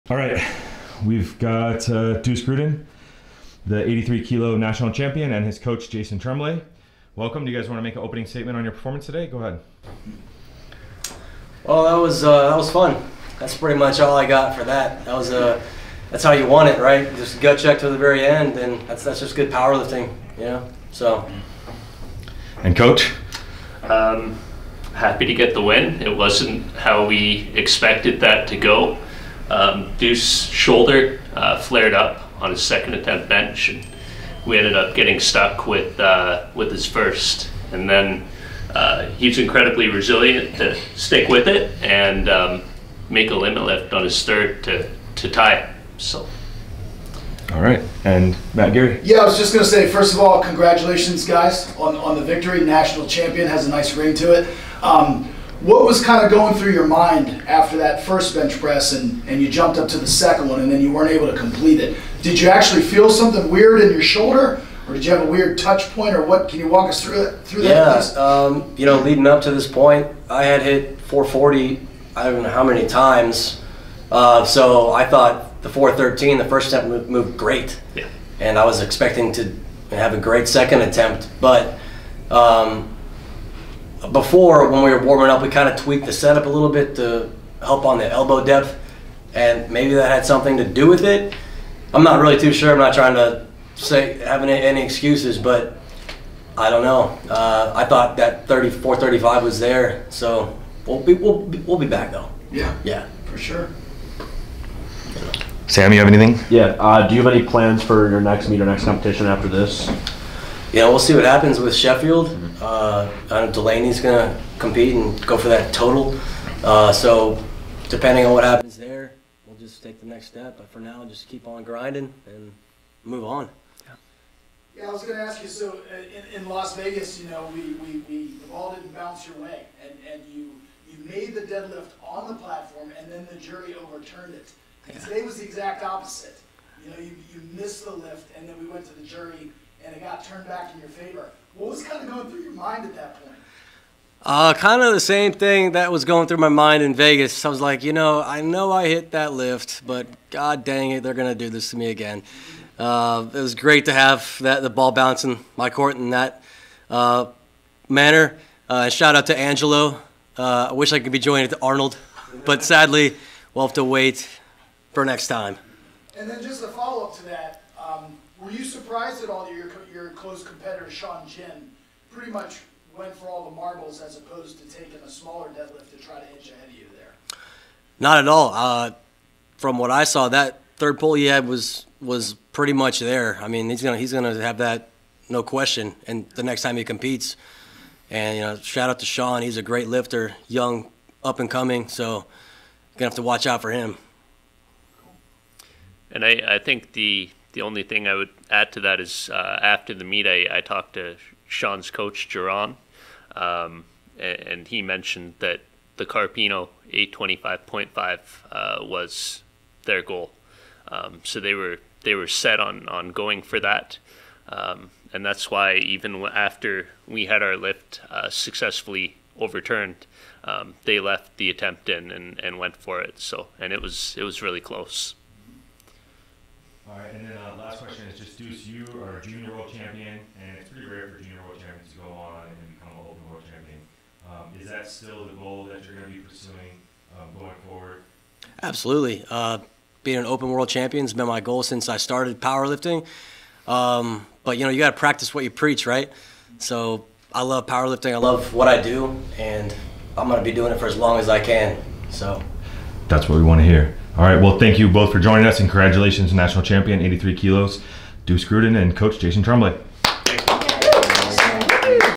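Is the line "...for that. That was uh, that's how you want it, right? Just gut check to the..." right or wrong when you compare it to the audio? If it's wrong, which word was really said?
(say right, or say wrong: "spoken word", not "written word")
right.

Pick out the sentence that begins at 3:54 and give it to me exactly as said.
Um, is that still the goal that you're going to be pursuing um, going forward?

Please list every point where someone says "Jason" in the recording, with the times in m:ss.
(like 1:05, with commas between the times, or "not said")
0:05, 4:19.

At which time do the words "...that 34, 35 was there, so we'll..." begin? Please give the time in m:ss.
1:38.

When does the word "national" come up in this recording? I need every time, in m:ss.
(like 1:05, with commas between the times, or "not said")
0:04, 0:52, 4:16.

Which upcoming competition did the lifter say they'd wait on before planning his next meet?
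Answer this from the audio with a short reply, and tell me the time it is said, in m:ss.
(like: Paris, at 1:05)
Sheffield, at 1:51.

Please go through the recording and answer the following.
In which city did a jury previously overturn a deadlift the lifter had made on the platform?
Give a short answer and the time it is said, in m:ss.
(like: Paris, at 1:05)
Las Vegas, at 2:06.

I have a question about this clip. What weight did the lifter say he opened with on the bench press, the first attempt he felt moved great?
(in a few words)
413.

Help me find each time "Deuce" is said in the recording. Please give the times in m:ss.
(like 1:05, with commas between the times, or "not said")
0:02, 0:29, 3:48, 4:18.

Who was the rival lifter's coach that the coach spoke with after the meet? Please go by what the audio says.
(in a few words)
Jerron.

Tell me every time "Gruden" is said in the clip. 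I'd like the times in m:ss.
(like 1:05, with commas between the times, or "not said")
0:02, 4:18.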